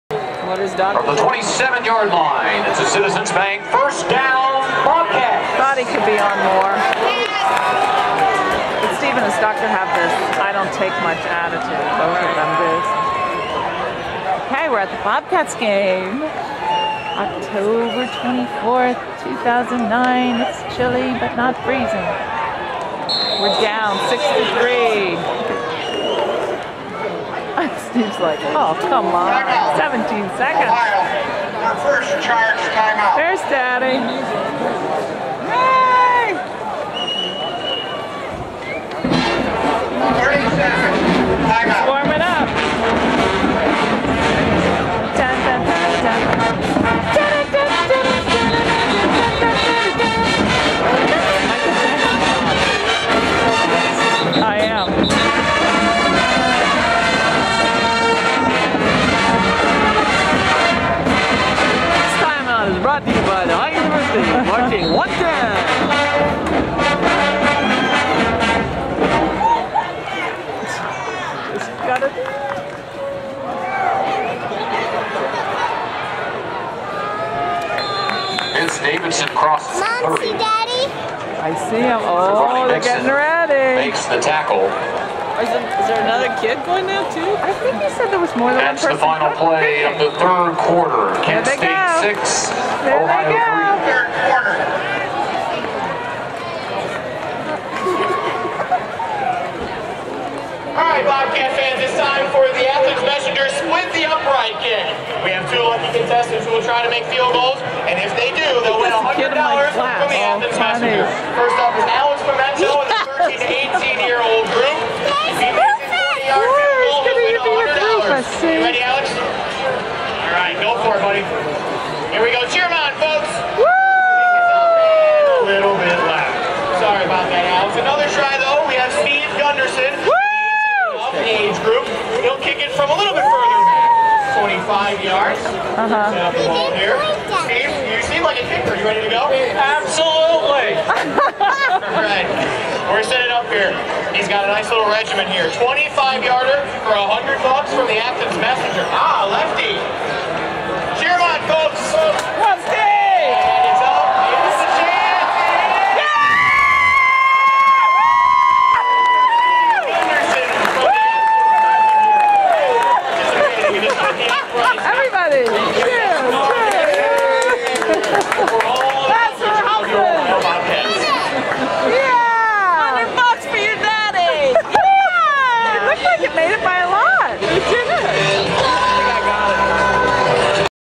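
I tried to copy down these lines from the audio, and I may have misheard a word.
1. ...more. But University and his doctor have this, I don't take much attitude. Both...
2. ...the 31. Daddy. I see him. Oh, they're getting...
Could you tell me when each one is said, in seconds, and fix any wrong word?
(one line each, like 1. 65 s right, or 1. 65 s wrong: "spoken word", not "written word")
1. 6 s wrong: "Steve", not "University"
2. 80 s wrong: "30", not "31".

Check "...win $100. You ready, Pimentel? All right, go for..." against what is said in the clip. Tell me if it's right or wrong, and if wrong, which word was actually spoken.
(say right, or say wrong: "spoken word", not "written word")
wrong: "Alex", not "Pimentel".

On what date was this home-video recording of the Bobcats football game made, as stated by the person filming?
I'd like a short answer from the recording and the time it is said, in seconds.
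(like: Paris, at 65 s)
October 24th, 2009, at 17 s.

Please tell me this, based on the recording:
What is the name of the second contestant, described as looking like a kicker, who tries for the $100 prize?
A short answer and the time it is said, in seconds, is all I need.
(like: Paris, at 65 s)
Steve Gunderson, at 129 s.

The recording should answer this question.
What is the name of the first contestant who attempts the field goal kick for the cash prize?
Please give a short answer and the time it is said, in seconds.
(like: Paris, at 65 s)
Alex Pimentel, at 111 s.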